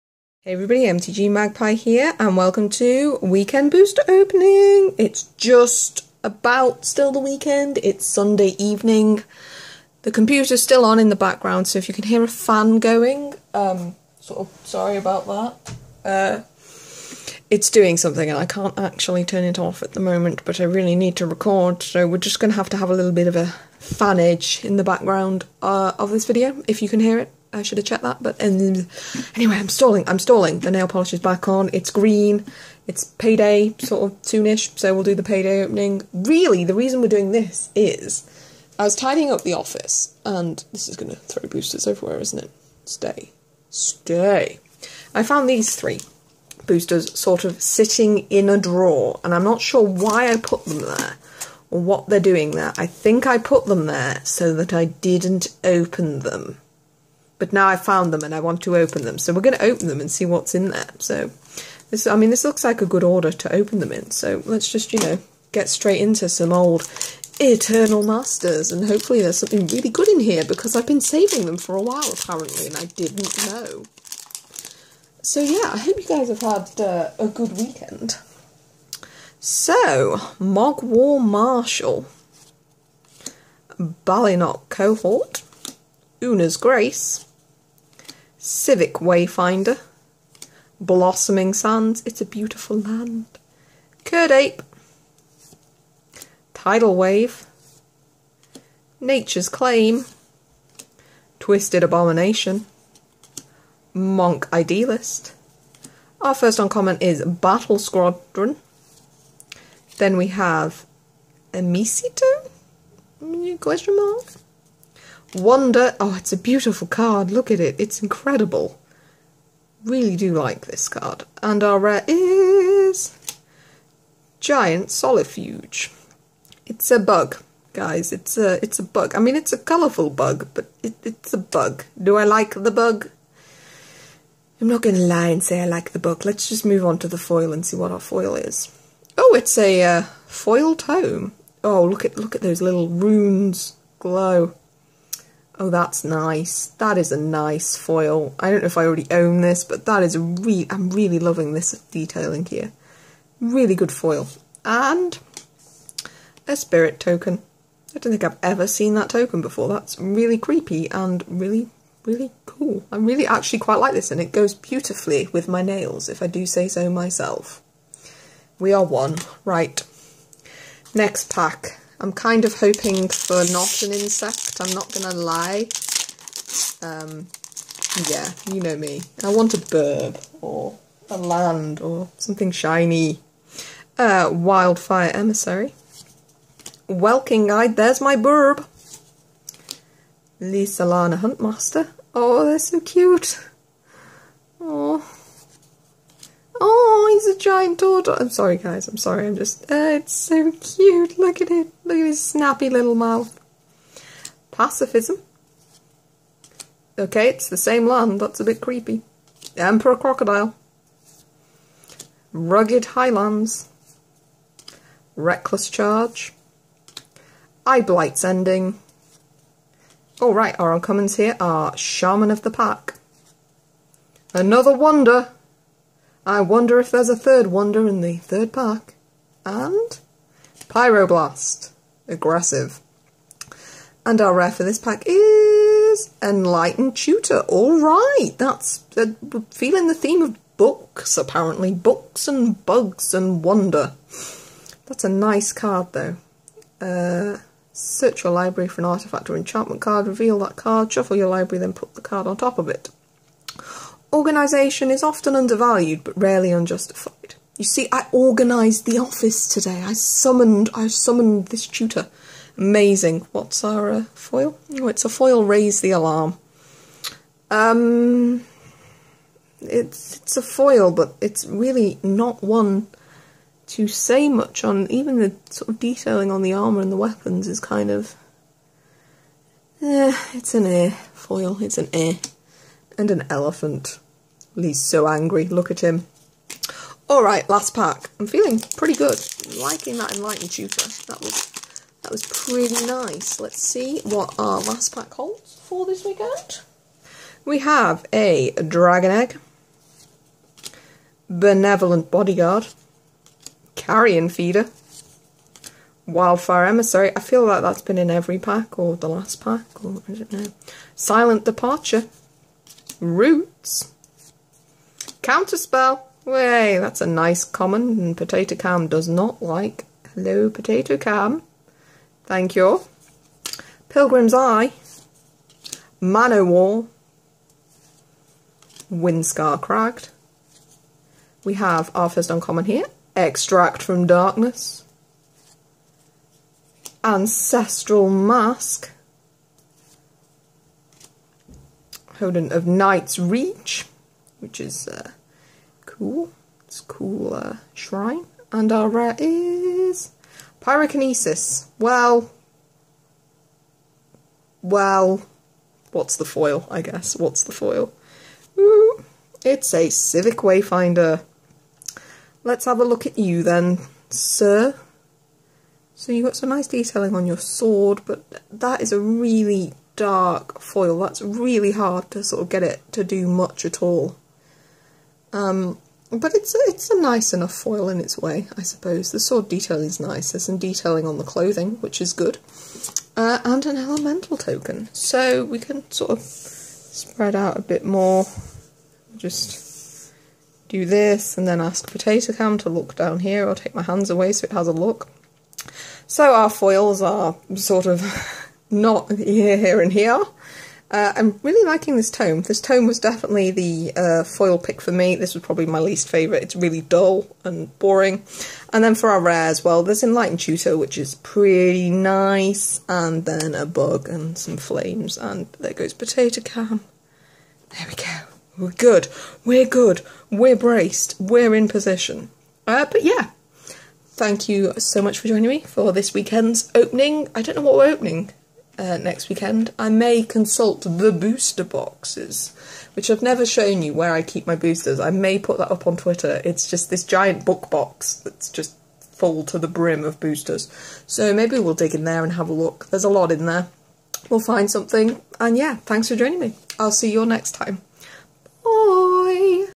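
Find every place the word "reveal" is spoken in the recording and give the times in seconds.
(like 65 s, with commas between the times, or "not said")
250 s.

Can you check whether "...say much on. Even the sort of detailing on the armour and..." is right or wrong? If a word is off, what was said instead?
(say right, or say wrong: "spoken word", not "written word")
right.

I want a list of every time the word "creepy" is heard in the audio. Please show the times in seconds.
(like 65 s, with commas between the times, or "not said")
160 s, 208 s.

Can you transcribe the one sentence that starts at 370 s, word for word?
That's really hard to sort of get it to do much at all.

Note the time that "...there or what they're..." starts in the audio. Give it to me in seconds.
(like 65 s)
50 s.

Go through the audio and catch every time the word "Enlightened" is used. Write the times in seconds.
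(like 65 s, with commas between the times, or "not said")
236 s, 290 s, 410 s.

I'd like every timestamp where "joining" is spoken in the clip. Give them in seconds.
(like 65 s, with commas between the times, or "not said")
425 s, 446 s.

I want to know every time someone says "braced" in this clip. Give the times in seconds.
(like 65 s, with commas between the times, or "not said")
420 s.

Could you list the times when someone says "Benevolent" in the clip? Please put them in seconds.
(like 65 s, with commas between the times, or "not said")
301 s.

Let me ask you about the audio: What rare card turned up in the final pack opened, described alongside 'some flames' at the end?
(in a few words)
Pyrokinesis.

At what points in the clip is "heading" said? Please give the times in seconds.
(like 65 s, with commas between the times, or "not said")
not said.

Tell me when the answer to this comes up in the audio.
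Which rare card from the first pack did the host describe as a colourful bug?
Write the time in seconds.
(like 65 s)
124 s.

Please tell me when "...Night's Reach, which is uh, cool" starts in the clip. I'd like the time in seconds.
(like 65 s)
342 s.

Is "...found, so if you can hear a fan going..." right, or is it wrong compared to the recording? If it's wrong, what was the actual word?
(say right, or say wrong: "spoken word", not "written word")
wrong: "background", not "found".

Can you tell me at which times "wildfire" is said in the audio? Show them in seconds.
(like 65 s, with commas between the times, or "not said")
184 s, 306 s.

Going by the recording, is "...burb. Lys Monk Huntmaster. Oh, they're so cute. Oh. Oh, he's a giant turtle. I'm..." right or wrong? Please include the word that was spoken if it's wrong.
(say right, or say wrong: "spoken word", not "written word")
wrong: "Alana", not "Monk".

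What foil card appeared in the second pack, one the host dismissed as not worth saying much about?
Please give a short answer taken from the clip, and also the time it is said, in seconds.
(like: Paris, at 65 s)
Raise the Alarm, at 265 s.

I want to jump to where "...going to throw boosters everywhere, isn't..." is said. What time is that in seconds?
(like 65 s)
40 s.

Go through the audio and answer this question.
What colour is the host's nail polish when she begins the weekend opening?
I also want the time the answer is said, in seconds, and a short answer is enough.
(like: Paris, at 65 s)
Green, at 31 s.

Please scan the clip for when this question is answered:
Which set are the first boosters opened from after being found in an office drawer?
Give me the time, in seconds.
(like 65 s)
67 s.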